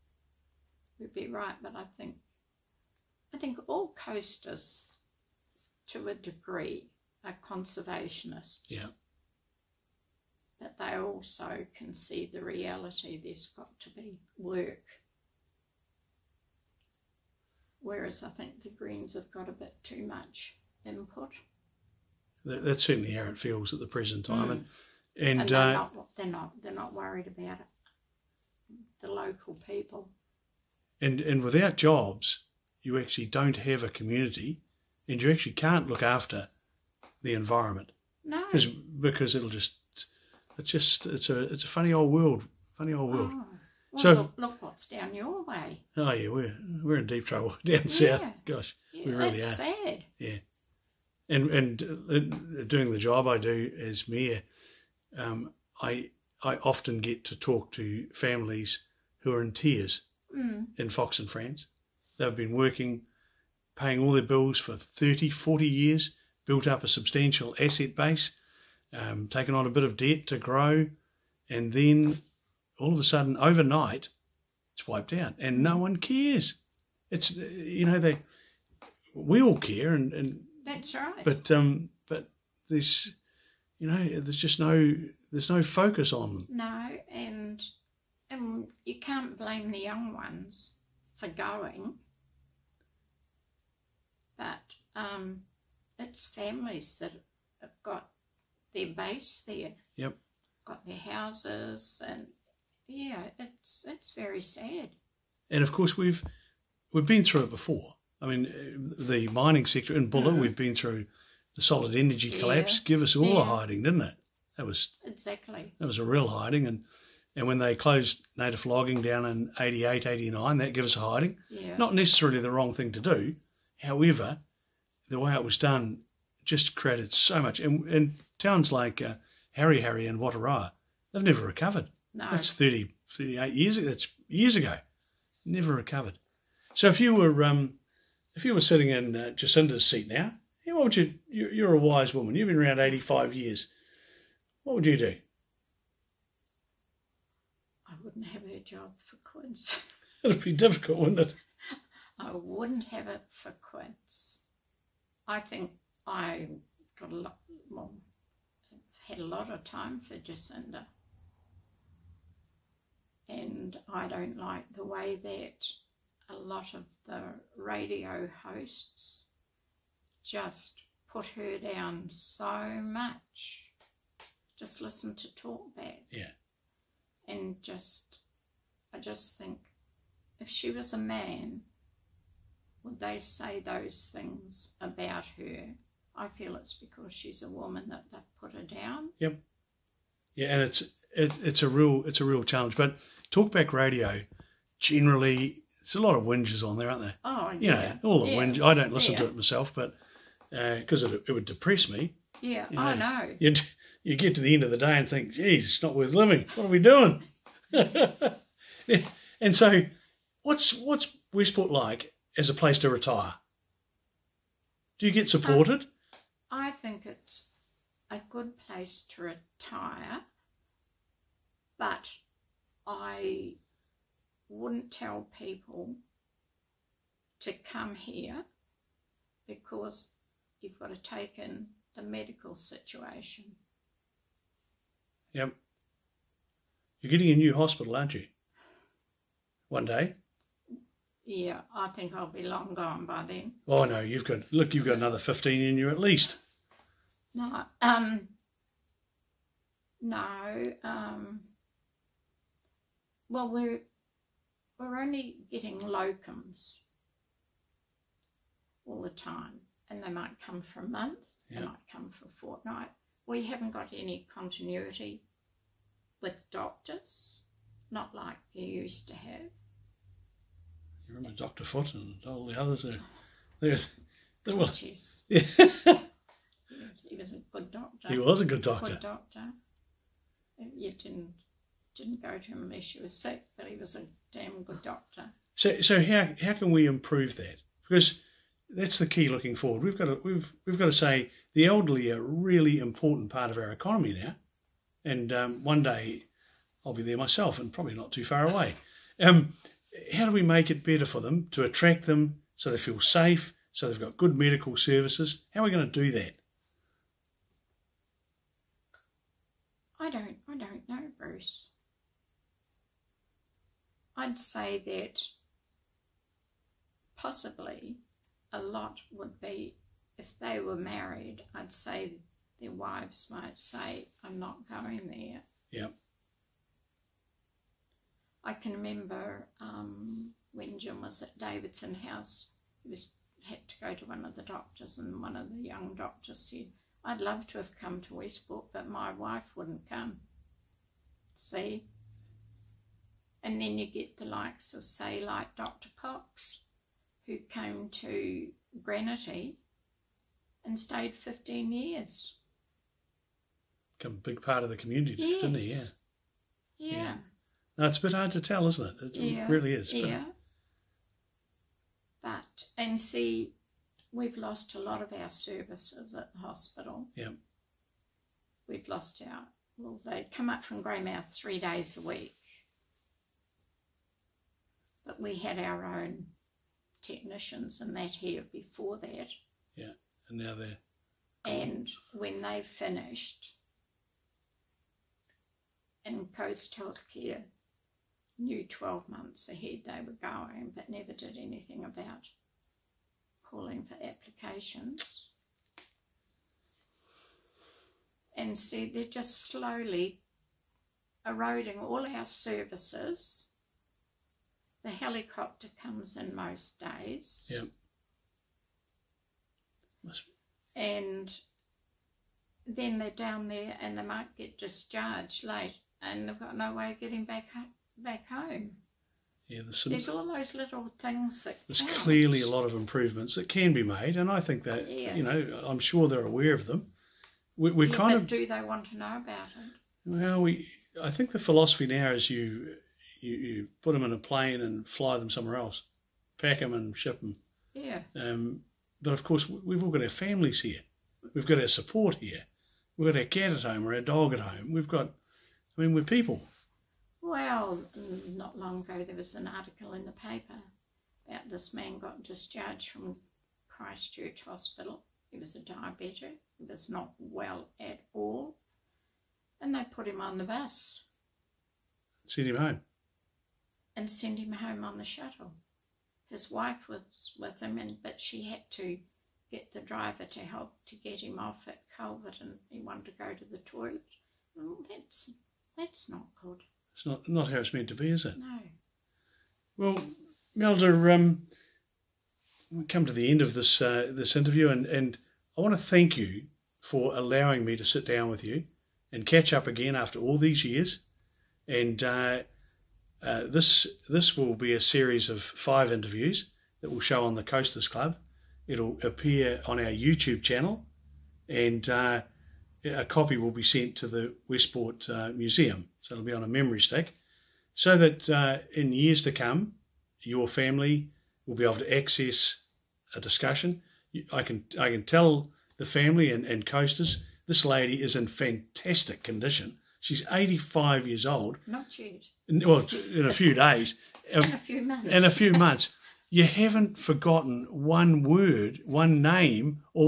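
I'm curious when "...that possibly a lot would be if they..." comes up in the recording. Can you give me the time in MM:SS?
05:14.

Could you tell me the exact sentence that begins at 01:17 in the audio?
It's you know they, we all care, and, and that's right.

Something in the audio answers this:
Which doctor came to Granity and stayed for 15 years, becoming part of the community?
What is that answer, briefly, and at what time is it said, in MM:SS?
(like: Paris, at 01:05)
Dr. Cox, at 05:45.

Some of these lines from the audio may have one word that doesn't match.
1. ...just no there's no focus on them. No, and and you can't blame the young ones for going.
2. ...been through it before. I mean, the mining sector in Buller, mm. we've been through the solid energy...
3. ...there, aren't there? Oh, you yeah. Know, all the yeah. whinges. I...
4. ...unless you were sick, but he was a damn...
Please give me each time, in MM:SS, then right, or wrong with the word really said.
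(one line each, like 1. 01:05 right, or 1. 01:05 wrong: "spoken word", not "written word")
1. 01:24 right
2. 01:47 right
3. 03:16 right
4. 04:42 right.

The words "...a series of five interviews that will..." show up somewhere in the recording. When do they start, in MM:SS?
08:14.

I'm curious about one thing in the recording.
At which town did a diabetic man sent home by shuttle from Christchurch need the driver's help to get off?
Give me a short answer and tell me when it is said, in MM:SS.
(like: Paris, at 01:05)
Culverden, at 07:51.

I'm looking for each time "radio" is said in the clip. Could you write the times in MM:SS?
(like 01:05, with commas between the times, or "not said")
02:47, 03:13.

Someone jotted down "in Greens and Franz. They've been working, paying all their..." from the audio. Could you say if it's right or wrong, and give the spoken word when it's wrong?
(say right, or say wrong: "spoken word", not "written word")
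wrong: "Fox", not "Greens".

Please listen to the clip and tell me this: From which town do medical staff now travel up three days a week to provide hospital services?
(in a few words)
Greymouth.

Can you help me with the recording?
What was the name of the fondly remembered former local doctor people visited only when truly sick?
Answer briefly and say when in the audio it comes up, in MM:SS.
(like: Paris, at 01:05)
Dr. Foot, at 04:31.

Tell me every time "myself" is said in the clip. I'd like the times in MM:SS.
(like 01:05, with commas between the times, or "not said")
03:19, 04:57.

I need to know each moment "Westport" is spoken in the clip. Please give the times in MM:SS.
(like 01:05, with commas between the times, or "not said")
03:31, 05:38, 08:24.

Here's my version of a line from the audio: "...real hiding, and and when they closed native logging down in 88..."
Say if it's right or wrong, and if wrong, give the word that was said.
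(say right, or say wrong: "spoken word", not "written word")
right.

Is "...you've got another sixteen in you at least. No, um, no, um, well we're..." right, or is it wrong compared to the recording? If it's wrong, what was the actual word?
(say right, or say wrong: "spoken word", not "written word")
wrong: "fifteen", not "sixteen".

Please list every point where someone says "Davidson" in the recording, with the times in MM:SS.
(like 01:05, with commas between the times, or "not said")
05:31.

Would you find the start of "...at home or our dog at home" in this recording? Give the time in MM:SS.
07:23.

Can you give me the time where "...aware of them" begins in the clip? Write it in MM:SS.
07:06.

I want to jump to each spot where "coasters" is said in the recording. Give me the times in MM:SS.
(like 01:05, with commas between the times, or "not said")
00:04, 08:17, 08:36.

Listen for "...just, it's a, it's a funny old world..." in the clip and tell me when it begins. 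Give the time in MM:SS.
00:40.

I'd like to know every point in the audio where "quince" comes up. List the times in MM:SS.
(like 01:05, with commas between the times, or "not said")
02:29, 02:33.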